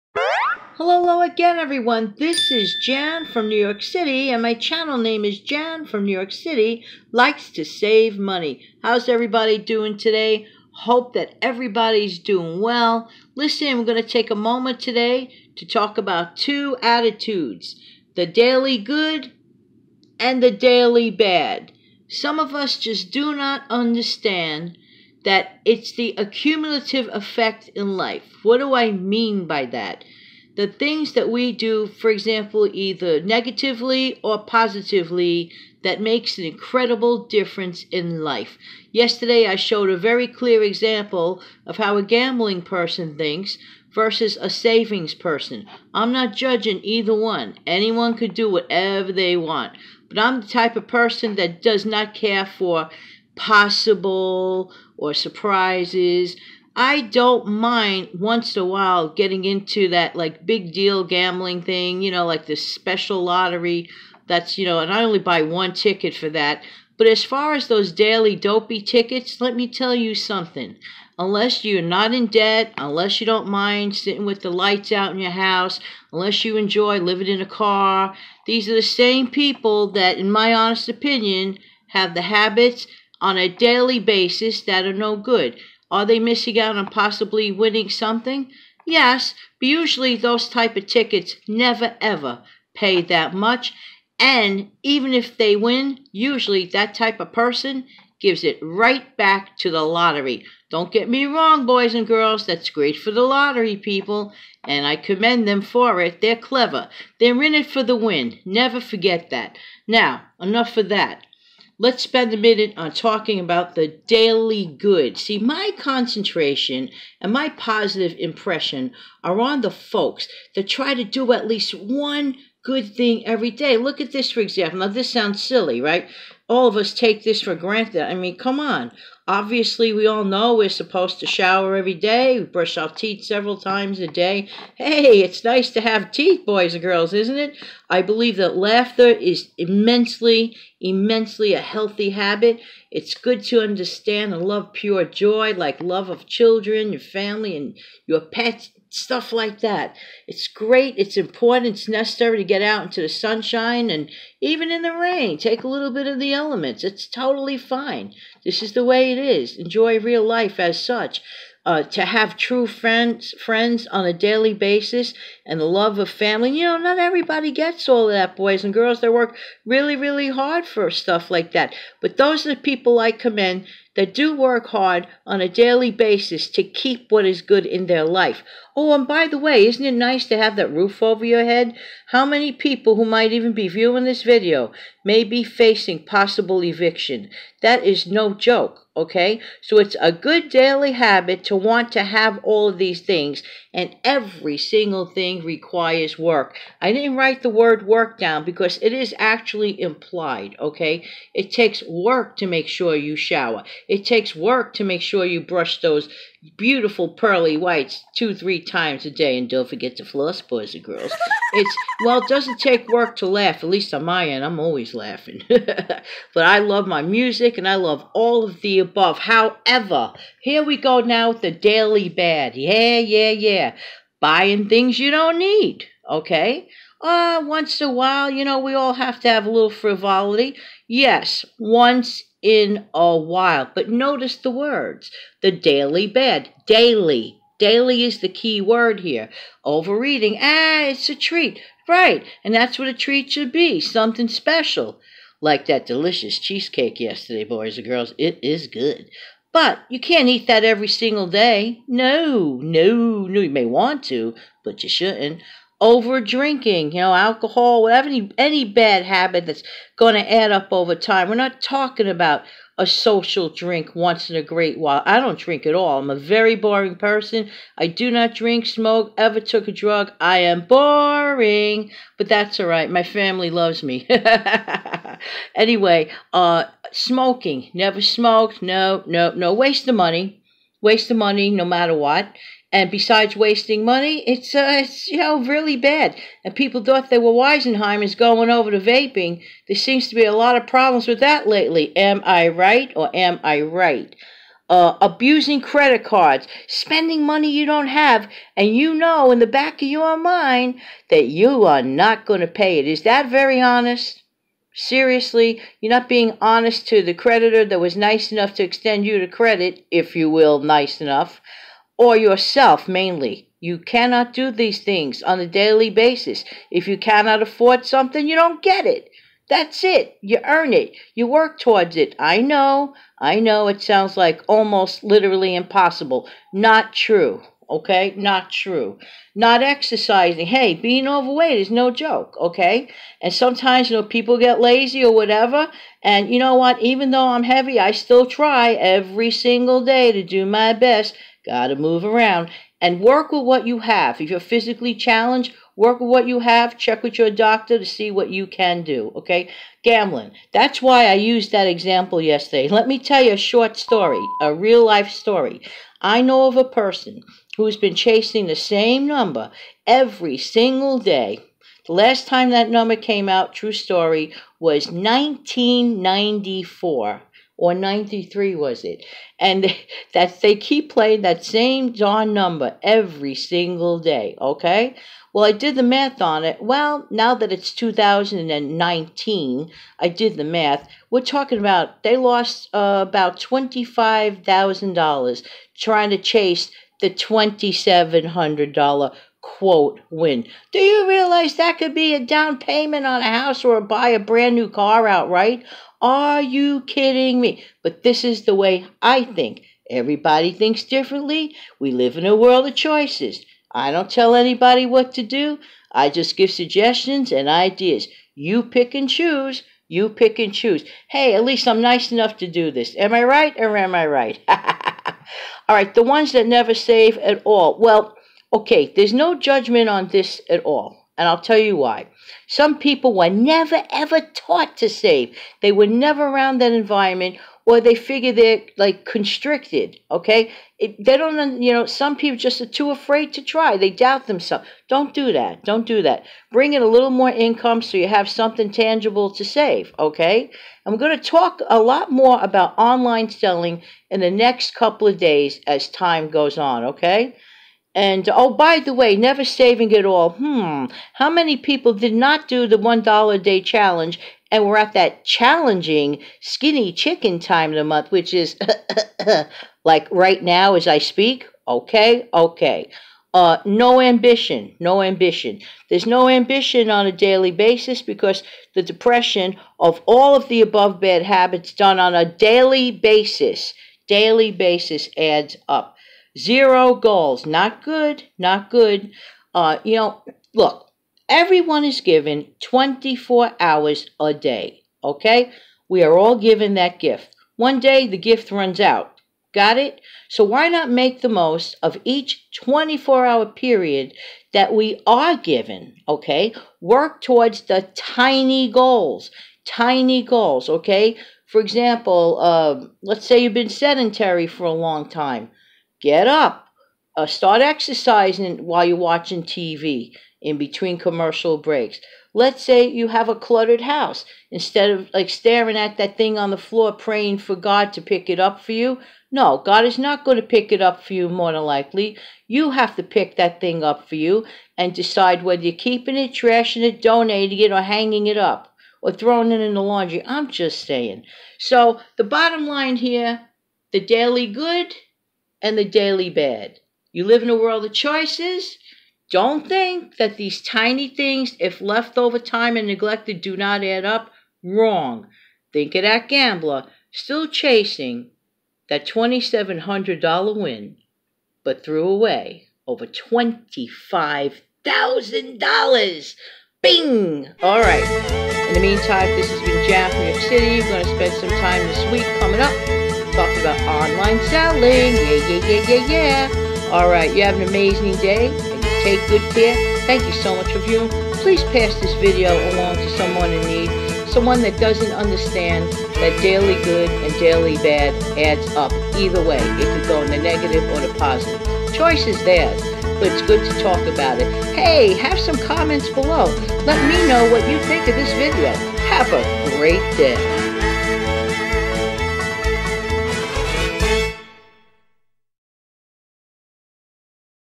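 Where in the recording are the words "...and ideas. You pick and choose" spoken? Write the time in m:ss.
6:47.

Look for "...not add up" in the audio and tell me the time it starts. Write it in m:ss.
9:03.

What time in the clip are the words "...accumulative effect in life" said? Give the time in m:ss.
0:26.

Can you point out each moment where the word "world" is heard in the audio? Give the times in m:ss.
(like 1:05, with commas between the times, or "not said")
6:42, 8:57.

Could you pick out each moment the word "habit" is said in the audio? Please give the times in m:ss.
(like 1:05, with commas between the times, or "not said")
1:22, 2:22, 3:10, 4:19, 7:51.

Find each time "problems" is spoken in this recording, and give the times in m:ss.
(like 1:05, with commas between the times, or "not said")
4:50.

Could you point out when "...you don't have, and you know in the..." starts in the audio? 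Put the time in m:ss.
4:57.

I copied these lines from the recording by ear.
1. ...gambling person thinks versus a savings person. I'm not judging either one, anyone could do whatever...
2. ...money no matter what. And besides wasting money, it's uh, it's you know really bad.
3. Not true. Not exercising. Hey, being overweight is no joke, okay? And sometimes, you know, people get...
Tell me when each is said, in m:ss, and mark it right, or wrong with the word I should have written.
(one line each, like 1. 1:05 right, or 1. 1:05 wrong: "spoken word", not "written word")
1. 0:42 right
2. 4:41 right
3. 5:28 right.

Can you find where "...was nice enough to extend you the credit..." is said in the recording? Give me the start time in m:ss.
5:07.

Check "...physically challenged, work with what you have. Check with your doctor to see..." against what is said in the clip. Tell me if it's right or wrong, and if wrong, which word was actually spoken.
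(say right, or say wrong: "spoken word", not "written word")
right.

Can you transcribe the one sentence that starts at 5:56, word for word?
I know of a person who's been chasing the same number every single day.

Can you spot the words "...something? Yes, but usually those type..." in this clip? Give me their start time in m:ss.
1:27.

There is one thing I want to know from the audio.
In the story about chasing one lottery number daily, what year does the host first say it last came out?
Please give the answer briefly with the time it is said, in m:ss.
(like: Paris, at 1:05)
1994, at 6:04.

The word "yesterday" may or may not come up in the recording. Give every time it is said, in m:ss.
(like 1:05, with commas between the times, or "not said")
0:38, 4:06, 5:52.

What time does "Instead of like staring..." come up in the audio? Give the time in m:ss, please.
8:34.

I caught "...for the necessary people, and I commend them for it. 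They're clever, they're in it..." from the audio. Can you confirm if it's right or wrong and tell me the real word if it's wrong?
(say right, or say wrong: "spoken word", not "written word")
wrong: "lottery", not "necessary".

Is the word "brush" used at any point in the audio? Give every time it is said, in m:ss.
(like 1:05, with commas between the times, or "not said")
2:12, 3:25.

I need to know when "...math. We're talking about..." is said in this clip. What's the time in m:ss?
6:20.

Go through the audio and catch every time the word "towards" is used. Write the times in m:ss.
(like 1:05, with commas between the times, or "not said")
5:21, 8:17.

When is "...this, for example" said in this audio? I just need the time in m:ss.
2:04.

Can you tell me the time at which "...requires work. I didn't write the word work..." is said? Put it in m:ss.
3:15.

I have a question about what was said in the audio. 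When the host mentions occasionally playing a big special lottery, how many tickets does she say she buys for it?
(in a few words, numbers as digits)
1.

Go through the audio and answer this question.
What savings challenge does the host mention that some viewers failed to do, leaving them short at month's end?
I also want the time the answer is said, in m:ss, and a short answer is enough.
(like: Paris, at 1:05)
$1 a day challenge, at 7:32.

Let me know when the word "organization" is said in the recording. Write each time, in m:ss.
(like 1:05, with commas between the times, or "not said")
not said.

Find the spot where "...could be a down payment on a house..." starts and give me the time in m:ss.
6:31.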